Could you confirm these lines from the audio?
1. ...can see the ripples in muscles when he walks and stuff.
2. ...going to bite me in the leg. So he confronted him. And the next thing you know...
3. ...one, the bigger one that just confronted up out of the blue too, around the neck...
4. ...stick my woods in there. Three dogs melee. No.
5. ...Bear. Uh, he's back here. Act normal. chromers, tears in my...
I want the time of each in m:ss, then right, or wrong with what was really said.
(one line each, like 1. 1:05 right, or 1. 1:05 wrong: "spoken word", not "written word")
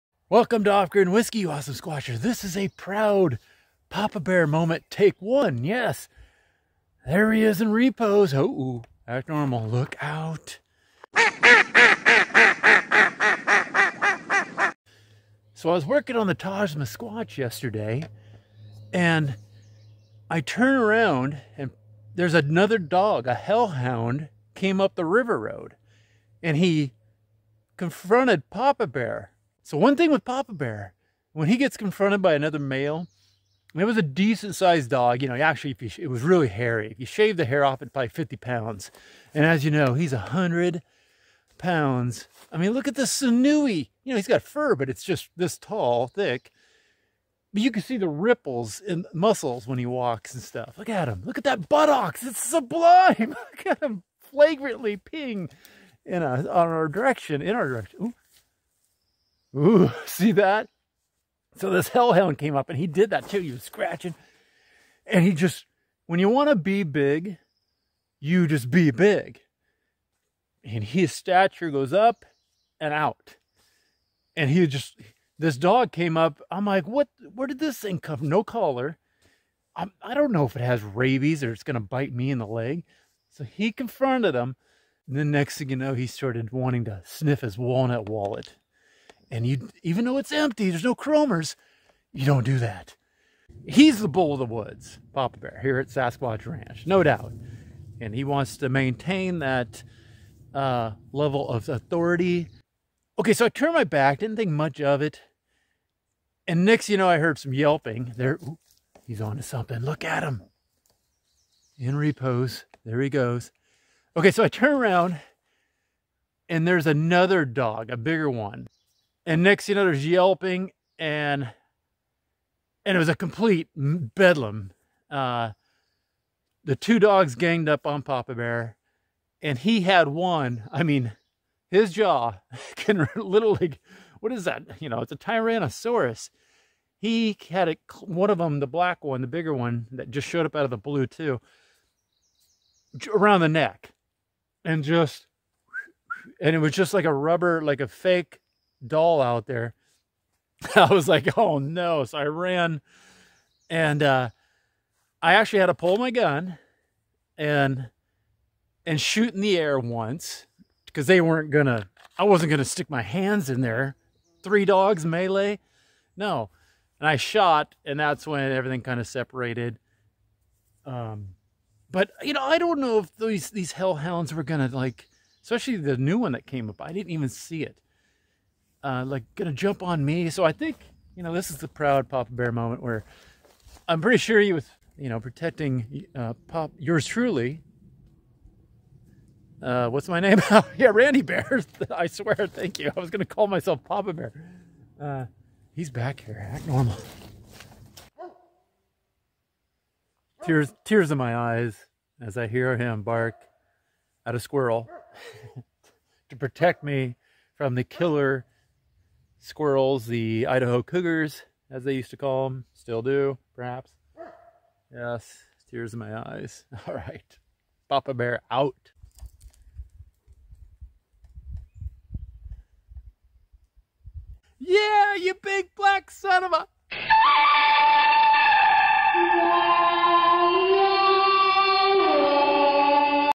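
1. 0:47 right
2. 1:21 right
3. 2:19 wrong: "showed", not "confronted"
4. 2:42 wrong: "hands", not "woods"
5. 3:14 wrong: "tears", not "chromers".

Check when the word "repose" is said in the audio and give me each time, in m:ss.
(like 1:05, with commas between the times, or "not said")
0:07, 1:51.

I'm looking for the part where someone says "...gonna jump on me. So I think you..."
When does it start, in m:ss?
2:59.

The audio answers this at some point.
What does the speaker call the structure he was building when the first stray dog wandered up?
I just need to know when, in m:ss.
0:16.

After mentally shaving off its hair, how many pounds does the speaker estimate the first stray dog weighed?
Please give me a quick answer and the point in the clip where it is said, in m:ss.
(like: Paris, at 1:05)
50, at 0:38.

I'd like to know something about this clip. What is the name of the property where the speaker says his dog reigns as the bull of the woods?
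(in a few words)
Sasquatch Ranch.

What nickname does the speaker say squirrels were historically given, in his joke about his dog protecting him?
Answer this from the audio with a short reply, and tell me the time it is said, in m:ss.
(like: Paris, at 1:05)
Idaho cougars, at 3:30.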